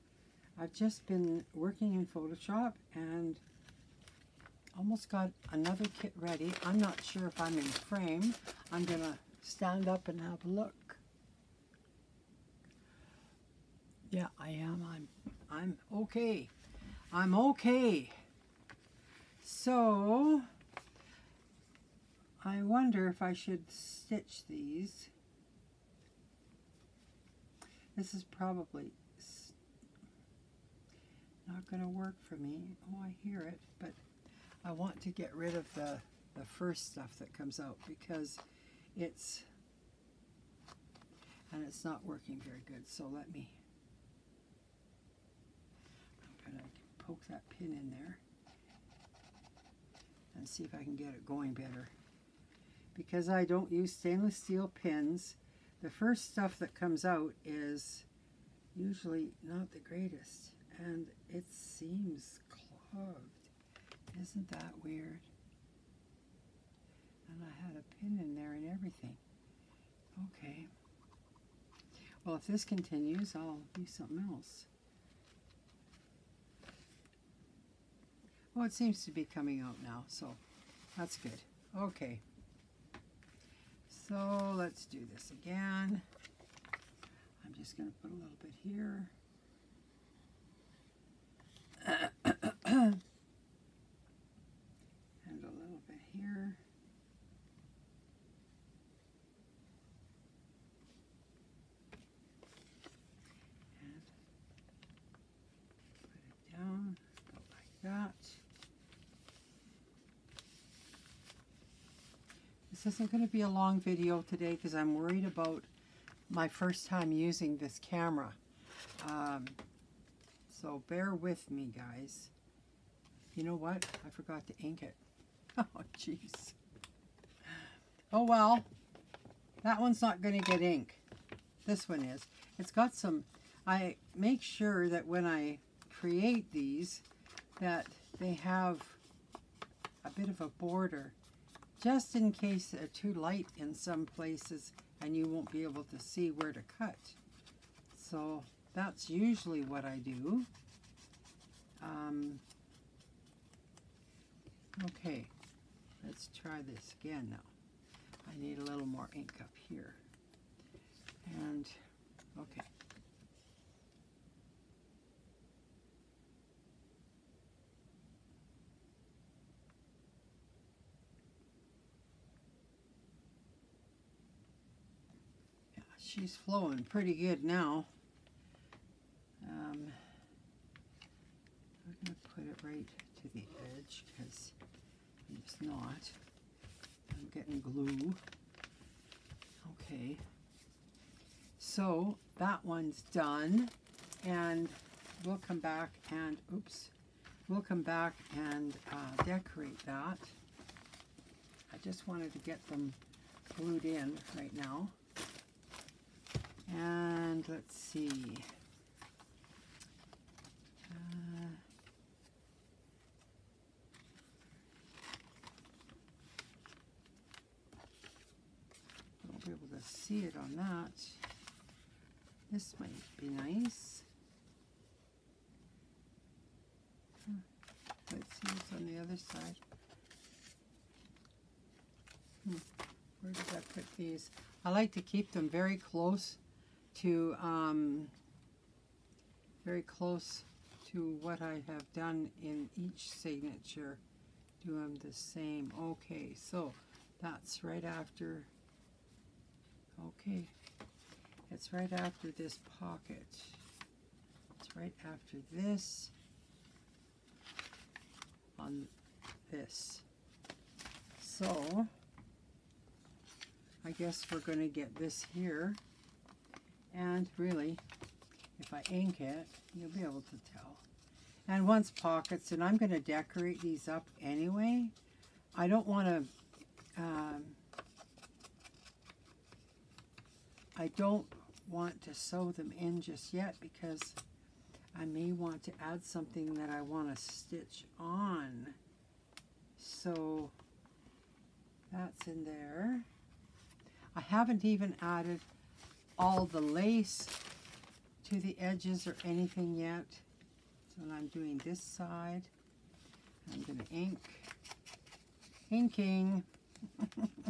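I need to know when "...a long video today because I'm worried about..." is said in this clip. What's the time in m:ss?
1:53.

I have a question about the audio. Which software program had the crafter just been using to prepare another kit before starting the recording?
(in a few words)
Photoshop.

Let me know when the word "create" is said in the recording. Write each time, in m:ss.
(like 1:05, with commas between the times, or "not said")
2:15.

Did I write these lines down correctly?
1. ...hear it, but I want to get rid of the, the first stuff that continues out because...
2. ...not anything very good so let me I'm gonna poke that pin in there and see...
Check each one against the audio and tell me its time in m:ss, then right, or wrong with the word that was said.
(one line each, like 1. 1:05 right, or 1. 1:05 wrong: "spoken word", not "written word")
1. 0:33 wrong: "comes", not "continues"
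2. 0:41 wrong: "working", not "anything".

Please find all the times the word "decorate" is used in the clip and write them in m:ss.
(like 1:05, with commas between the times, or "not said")
3:19, 4:32.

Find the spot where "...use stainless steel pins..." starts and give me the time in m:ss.
0:53.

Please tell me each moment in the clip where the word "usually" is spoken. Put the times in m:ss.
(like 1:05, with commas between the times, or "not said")
0:58, 2:29.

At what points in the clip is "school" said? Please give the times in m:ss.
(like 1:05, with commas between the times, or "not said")
not said.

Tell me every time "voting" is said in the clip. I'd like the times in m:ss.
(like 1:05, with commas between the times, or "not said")
not said.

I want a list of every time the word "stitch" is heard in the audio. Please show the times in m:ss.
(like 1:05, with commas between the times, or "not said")
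0:23, 4:47.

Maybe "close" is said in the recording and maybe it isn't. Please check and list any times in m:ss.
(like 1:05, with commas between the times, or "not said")
3:55, 3:59.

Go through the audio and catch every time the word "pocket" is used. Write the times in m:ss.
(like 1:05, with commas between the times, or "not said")
4:12, 4:31.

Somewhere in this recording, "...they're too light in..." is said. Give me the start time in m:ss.
2:22.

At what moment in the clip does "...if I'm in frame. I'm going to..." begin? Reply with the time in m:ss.
0:07.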